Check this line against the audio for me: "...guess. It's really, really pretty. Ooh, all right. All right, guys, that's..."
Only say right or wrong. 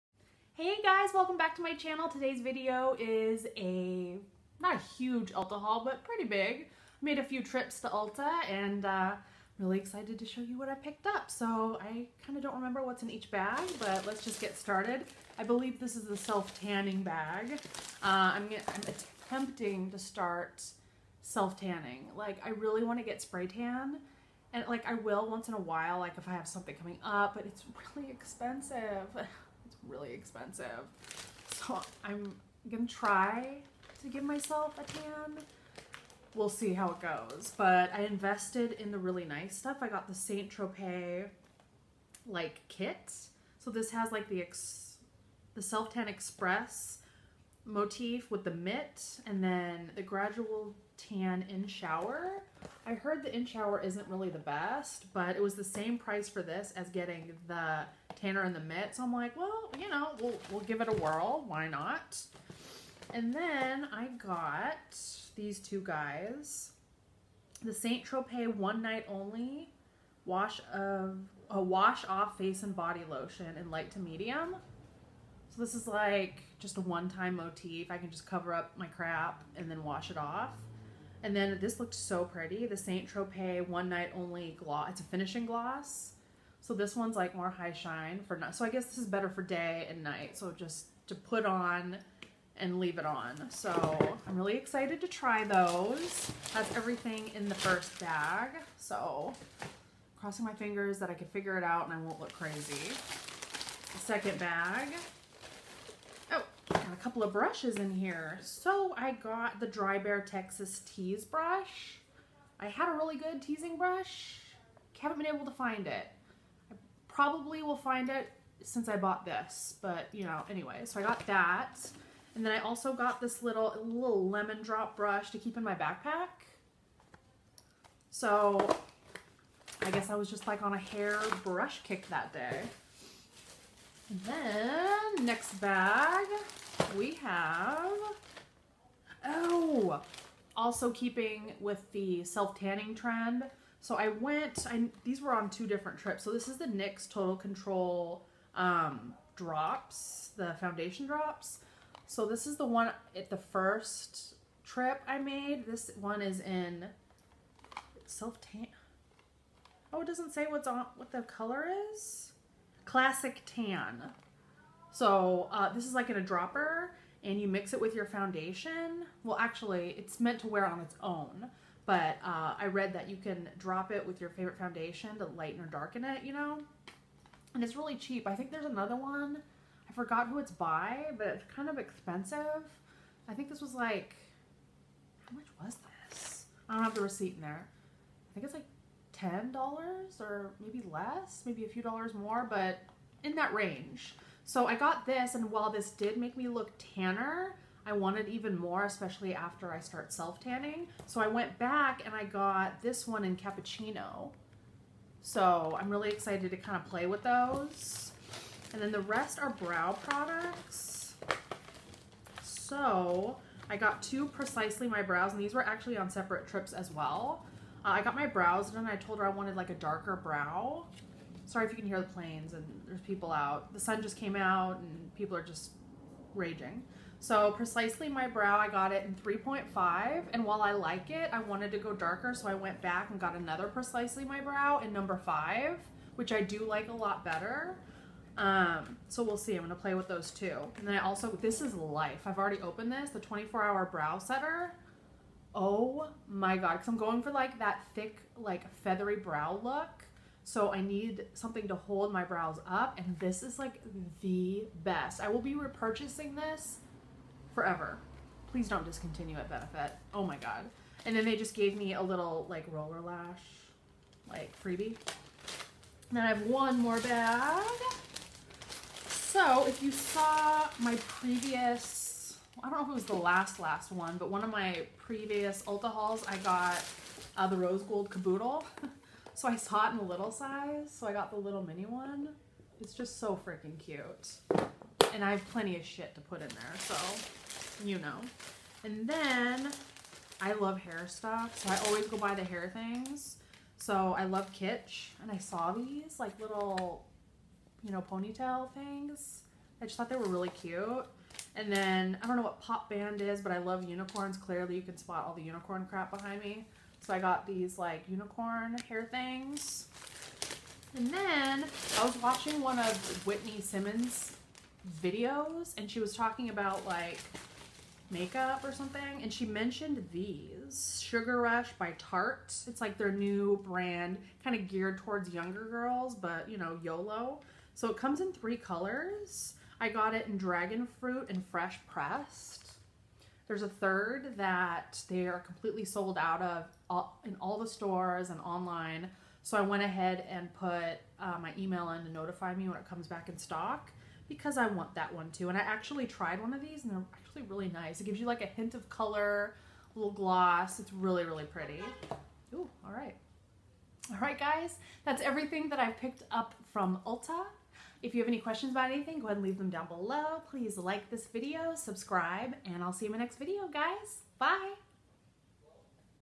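wrong.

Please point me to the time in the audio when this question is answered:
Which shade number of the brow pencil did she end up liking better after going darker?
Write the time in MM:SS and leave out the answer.
03:54.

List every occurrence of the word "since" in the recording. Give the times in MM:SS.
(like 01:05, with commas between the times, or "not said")
01:58.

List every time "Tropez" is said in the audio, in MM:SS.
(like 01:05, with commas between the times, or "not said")
00:40, 01:08, 01:23.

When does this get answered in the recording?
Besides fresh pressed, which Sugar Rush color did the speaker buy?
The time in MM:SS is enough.
05:30.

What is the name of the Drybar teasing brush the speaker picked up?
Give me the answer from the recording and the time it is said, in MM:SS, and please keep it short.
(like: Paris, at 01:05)
Texas Tease, at 01:50.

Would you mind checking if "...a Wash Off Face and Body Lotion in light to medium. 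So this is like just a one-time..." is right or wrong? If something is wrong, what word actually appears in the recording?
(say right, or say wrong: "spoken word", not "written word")
right.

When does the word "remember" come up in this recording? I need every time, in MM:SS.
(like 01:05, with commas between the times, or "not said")
00:12.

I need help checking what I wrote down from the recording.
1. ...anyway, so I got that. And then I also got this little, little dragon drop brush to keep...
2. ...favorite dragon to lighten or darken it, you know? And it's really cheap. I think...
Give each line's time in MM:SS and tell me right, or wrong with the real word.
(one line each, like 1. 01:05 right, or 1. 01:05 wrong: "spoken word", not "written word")
1. 02:00 wrong: "lemon", not "dragon"
2. 02:54 wrong: "foundation", not "dragon".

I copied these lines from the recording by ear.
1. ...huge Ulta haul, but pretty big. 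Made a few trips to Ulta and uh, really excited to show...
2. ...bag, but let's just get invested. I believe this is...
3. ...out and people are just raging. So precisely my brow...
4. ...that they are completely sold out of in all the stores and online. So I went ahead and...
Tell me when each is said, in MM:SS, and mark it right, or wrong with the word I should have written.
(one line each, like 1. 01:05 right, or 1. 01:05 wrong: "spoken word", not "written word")
1. 00:04 right
2. 00:13 wrong: "started", not "invested"
3. 03:44 right
4. 05:34 right.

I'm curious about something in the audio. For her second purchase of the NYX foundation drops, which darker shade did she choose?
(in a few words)
cappuccino.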